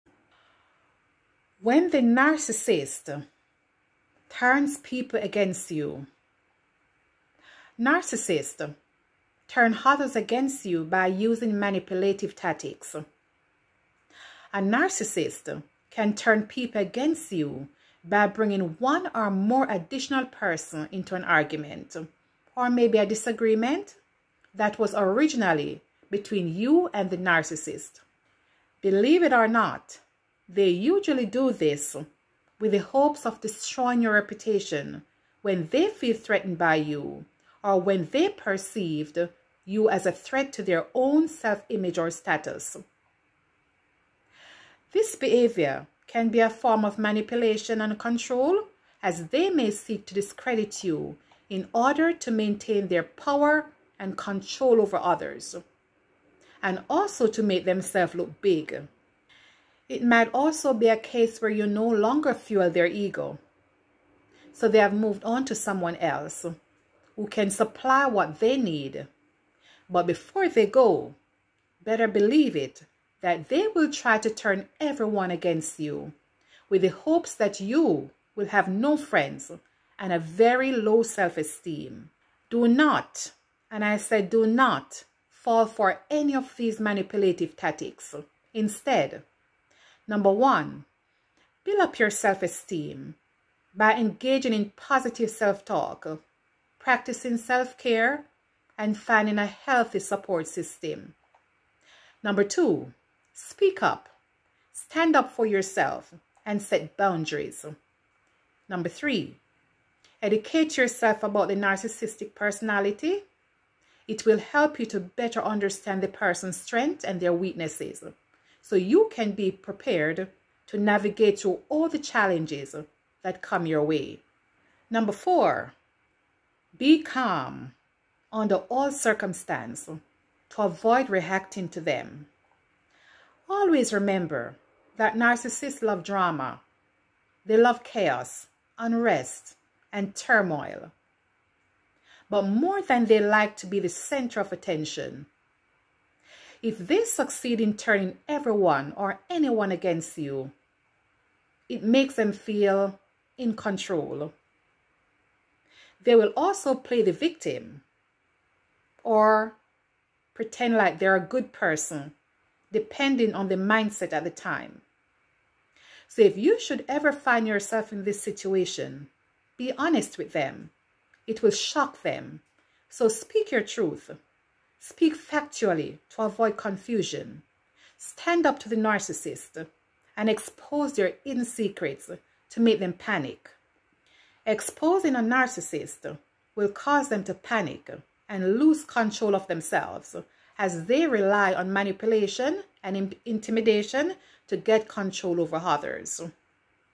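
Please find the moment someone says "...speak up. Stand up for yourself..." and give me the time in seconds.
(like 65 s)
103 s.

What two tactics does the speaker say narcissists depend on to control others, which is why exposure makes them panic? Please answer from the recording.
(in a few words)
manipulation and intimidation.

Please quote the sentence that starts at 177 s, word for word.
Stand up to the narcissist and expose their hidden secrets to make them panic.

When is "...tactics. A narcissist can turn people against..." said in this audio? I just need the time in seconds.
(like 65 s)
12 s.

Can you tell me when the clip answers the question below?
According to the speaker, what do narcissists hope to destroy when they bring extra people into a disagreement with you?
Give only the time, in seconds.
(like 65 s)
34 s.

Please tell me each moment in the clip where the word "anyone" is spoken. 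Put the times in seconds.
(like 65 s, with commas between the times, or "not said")
149 s.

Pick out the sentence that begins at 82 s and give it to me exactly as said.
Do not, and I said do not, fall for any of these manipulative tactics.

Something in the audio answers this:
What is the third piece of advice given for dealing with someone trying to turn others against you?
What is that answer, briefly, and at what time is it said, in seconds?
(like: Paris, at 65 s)
educate yourself, at 110 s.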